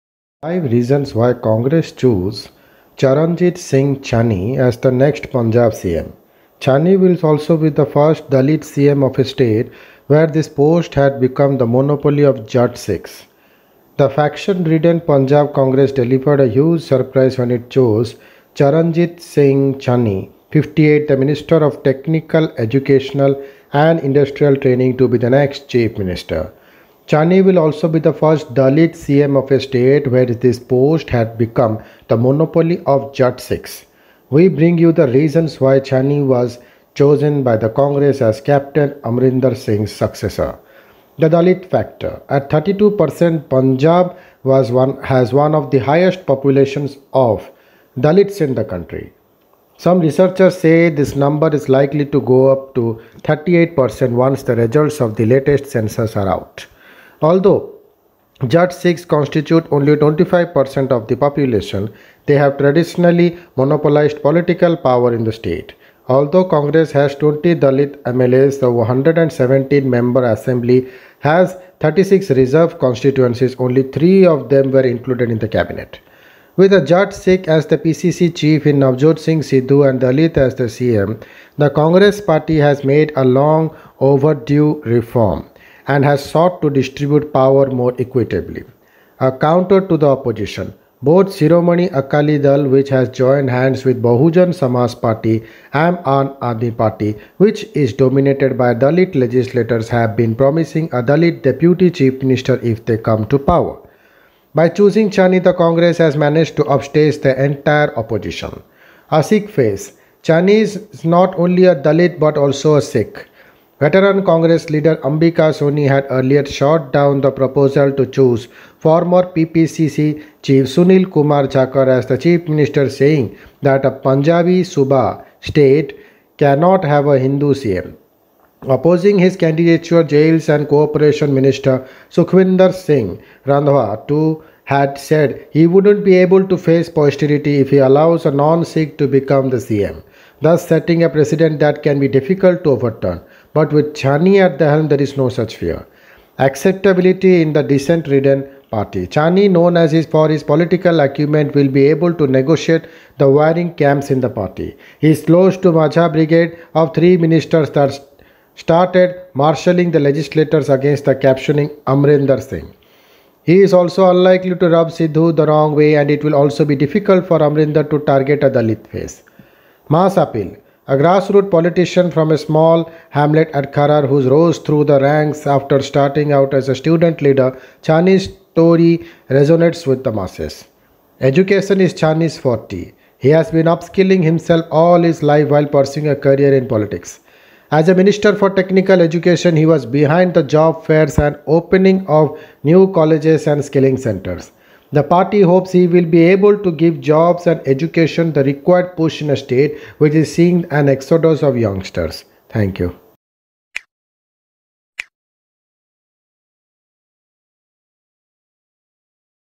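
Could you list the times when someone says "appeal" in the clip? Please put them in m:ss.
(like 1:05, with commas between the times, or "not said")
2:50.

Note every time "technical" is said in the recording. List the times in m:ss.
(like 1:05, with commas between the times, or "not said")
0:21, 3:08.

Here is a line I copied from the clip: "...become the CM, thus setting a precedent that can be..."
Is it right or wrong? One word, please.
right.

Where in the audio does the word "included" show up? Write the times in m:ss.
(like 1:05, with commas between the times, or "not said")
1:14.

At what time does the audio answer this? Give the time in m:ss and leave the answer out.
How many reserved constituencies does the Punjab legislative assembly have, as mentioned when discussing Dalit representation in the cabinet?
1:11.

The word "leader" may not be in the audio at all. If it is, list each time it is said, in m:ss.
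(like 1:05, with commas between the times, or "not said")
1:54, 2:57.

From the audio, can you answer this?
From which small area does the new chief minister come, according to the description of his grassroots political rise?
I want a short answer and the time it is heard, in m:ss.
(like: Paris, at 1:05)
Kharar, at 2:53.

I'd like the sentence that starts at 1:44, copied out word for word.
By choosing Channi, the Congress has managed to upstage the entire opposition.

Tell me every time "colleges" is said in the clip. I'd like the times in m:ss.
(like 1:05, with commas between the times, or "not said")
3:12.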